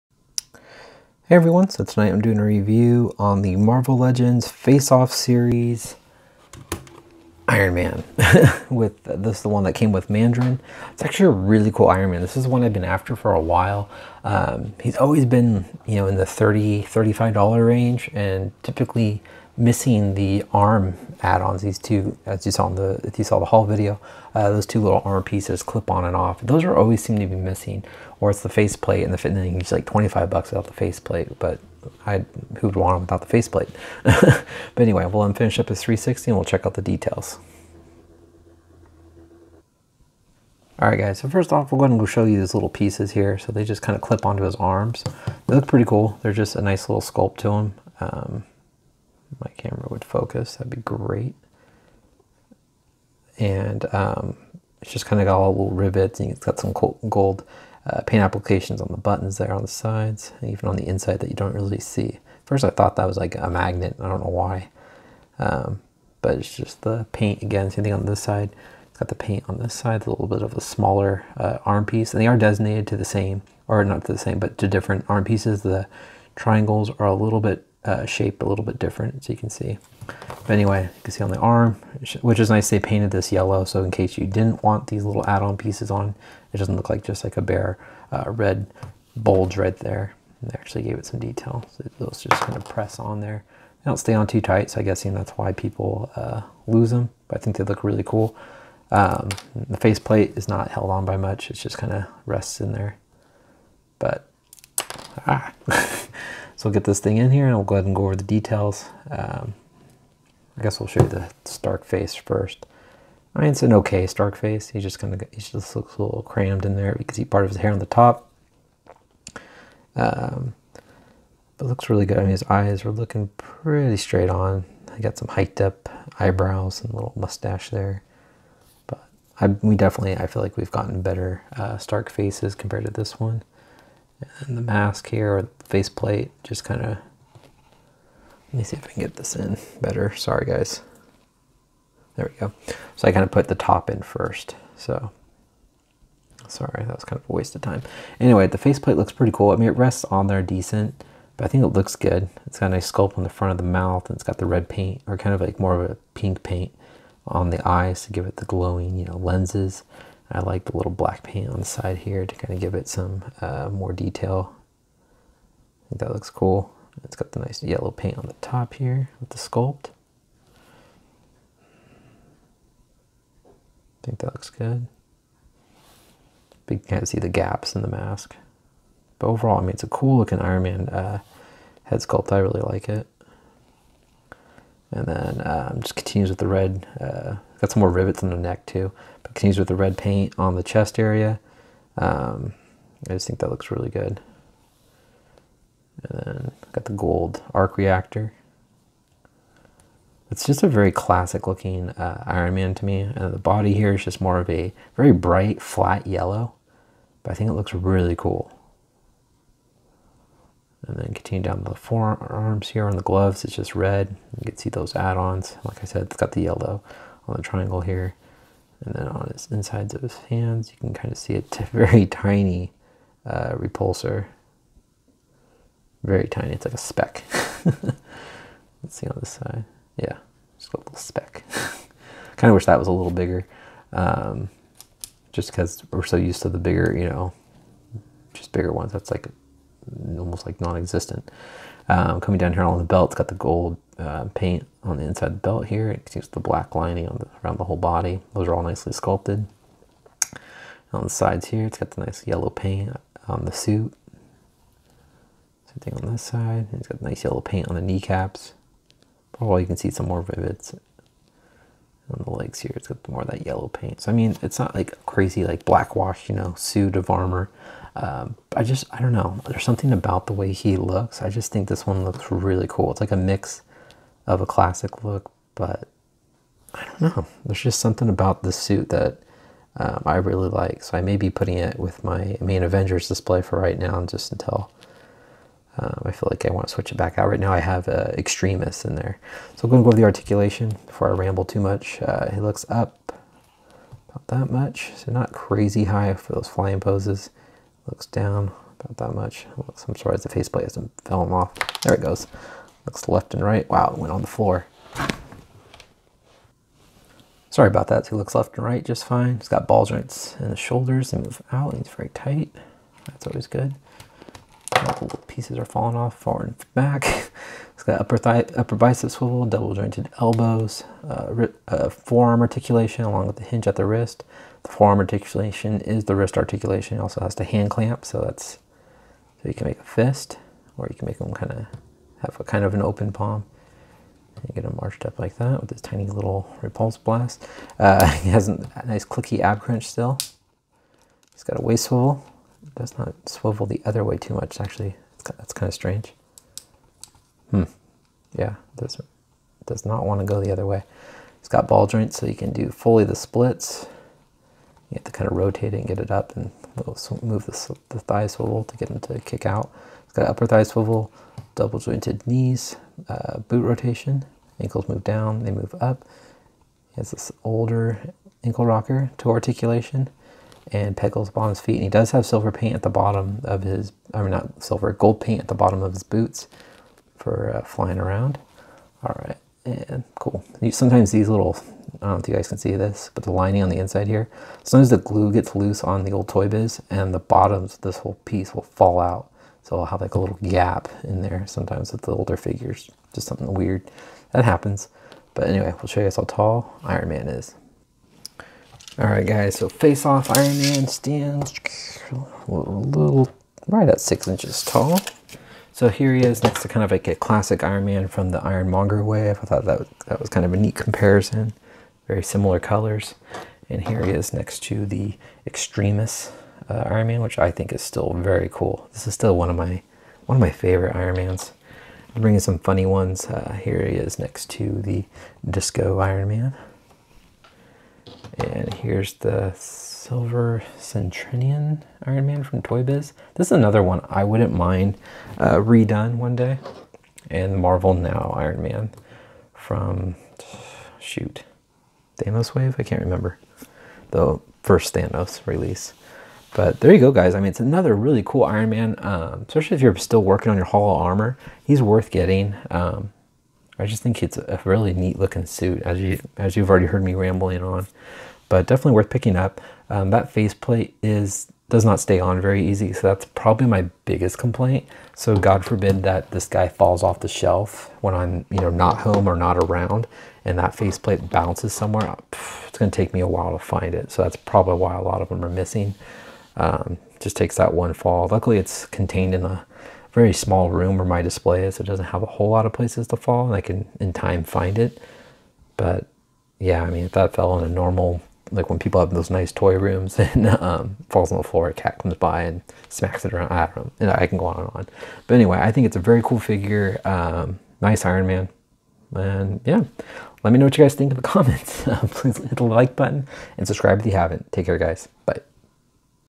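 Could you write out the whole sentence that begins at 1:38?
Um, the faceplate is not held on by much, it just kind of rests in there.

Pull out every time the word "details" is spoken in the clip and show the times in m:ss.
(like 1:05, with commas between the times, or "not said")
0:36, 1:31, 1:48, 2:43.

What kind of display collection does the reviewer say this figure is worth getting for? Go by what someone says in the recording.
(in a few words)
Hall of Armor.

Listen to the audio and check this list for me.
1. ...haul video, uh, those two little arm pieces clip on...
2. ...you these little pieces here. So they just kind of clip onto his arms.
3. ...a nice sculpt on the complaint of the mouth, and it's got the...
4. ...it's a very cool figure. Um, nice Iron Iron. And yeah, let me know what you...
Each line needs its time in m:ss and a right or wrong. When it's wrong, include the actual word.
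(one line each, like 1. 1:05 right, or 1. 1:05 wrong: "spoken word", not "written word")
1. 0:23 right
2. 0:42 right
3. 2:32 wrong: "front", not "complaint"
4. 8:15 wrong: "Man", not "Iron".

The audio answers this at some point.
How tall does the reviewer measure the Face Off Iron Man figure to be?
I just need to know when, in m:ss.
6:44.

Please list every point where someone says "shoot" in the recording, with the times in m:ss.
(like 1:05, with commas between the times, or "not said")
7:20.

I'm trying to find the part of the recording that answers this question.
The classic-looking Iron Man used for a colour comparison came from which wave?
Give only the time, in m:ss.
6:48.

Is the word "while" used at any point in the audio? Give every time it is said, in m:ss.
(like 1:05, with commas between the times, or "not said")
0:13, 7:53.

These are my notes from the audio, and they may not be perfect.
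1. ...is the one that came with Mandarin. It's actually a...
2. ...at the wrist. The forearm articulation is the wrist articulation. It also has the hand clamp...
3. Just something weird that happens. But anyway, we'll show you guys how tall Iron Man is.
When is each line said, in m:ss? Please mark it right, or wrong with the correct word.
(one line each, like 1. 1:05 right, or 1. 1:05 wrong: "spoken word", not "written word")
1. 0:09 right
2. 5:23 right
3. 6:33 right.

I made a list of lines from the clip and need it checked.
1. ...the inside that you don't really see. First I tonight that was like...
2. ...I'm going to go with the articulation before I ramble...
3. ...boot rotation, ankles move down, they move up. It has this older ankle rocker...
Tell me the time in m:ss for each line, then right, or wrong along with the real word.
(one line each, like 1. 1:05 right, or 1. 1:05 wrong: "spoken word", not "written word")
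1. 1:00 wrong: "thought", not "tonight"
2. 4:49 right
3. 6:03 right.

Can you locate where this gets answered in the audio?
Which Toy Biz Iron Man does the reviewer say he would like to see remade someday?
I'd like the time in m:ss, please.
7:09.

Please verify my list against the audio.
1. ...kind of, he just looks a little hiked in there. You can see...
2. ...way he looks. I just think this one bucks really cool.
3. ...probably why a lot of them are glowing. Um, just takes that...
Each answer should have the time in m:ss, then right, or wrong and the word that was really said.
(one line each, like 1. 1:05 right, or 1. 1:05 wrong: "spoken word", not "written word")
1. 1:54 wrong: "crammed", not "hiked"
2. 4:30 wrong: "looks", not "bucks"
3. 7:54 wrong: "missing", not "glowing".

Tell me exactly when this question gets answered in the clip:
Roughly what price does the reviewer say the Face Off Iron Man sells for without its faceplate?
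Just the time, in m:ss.
0:29.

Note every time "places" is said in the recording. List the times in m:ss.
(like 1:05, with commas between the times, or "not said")
8:02.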